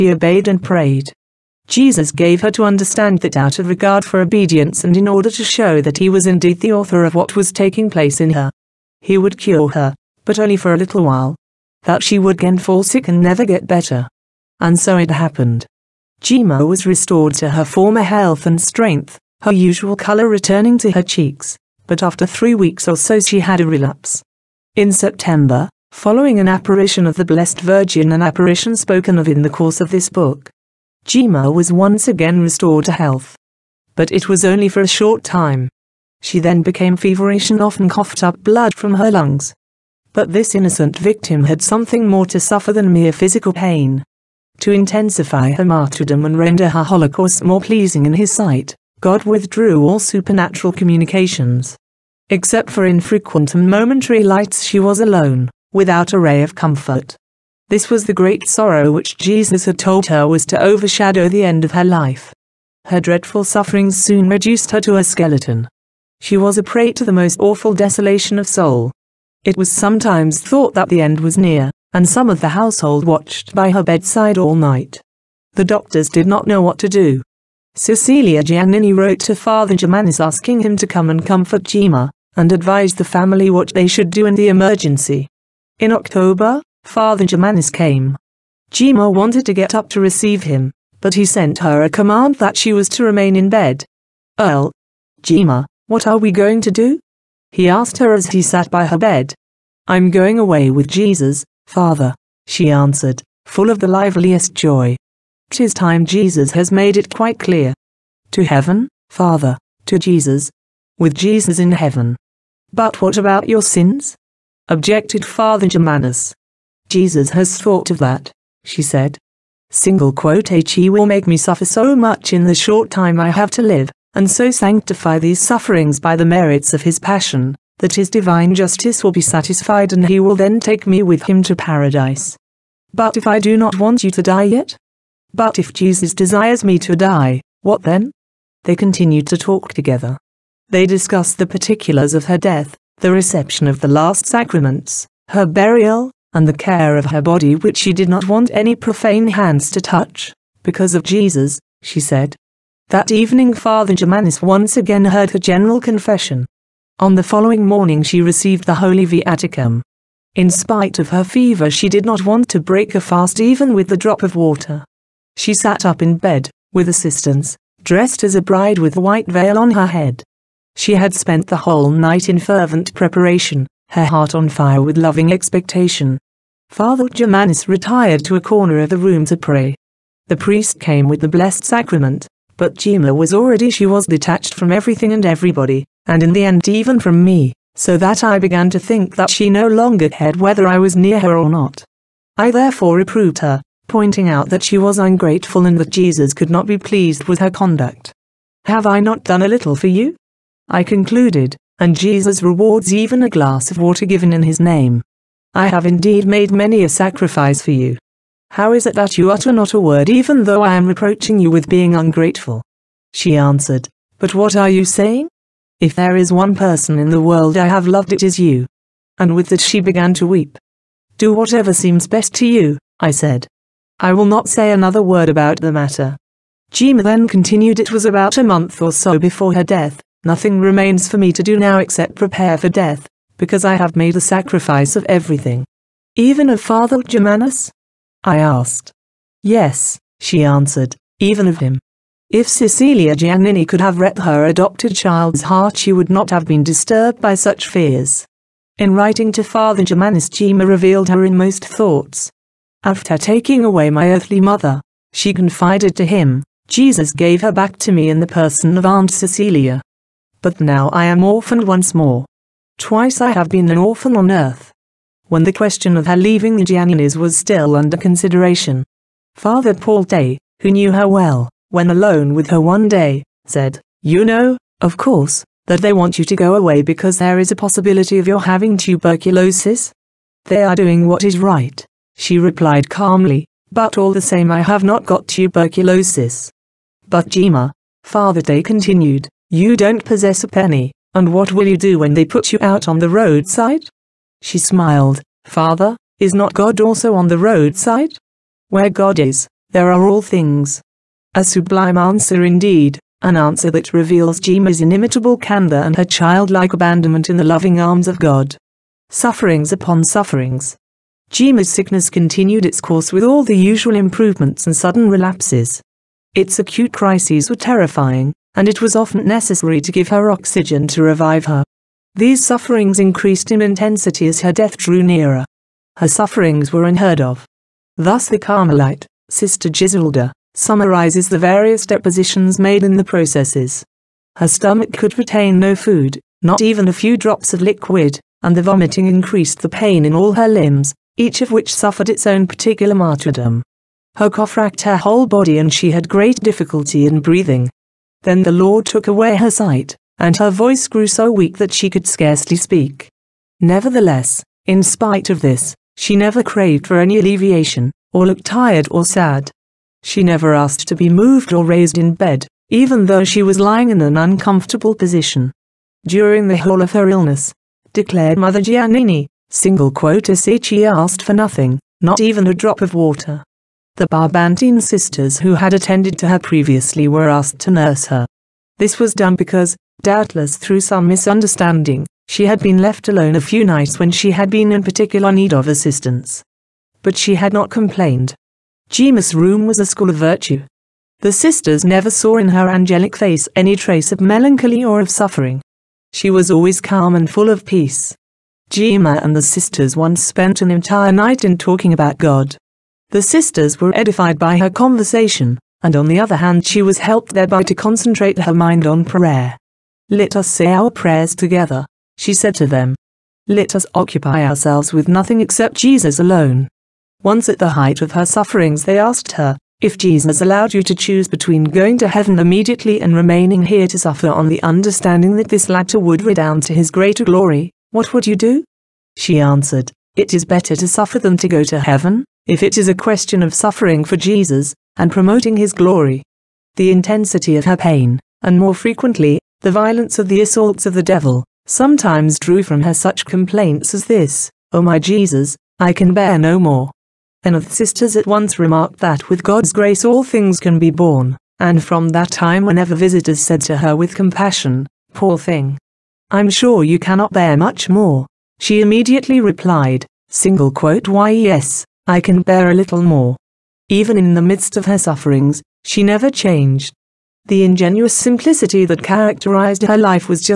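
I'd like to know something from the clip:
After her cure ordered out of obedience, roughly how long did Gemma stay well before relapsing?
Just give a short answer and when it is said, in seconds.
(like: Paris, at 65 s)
3 weeks, at 22 s.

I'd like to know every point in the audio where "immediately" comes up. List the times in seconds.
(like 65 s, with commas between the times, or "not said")
422 s, 458 s.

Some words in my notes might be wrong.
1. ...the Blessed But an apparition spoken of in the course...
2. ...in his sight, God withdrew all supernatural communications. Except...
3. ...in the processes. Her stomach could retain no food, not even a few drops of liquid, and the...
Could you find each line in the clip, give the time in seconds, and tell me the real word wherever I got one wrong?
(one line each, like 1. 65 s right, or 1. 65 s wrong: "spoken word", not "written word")
1. 27 s wrong: "Virgin", not "But"
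2. 48 s right
3. 332 s right.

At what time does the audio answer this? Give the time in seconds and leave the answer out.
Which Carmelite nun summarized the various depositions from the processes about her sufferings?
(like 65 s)
329 s.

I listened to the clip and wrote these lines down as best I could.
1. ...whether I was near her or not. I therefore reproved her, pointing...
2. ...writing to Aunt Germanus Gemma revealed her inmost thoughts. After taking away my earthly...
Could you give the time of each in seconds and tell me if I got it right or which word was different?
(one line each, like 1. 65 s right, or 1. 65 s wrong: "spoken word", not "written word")
1. 190 s right
2. 248 s wrong: "Father", not "Aunt".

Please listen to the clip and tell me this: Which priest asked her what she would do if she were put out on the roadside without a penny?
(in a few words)
Father Paul Day.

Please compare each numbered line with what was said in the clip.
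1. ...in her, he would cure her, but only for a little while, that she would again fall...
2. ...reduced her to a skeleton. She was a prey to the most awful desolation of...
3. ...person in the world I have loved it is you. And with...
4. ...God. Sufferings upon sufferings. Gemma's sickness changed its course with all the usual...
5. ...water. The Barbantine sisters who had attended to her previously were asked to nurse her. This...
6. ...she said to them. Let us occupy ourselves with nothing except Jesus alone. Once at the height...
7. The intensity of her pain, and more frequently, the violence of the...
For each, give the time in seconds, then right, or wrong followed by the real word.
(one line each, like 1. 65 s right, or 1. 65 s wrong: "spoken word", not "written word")
1. 8 s right
2. 64 s right
3. 216 s right
4. 308 s wrong: "continued", not "changed"
5. 372 s right
6. 412 s right
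7. 436 s right.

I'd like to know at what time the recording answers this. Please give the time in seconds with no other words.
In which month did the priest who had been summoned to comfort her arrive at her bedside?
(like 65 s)
85 s.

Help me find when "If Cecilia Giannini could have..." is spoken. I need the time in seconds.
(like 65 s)
242 s.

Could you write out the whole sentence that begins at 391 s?
The sisters never saw in her angelic face any trace of melancholy or of suffering.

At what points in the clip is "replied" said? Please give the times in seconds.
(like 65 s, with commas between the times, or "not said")
282 s, 459 s.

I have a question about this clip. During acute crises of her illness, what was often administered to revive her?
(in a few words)
Oxygen.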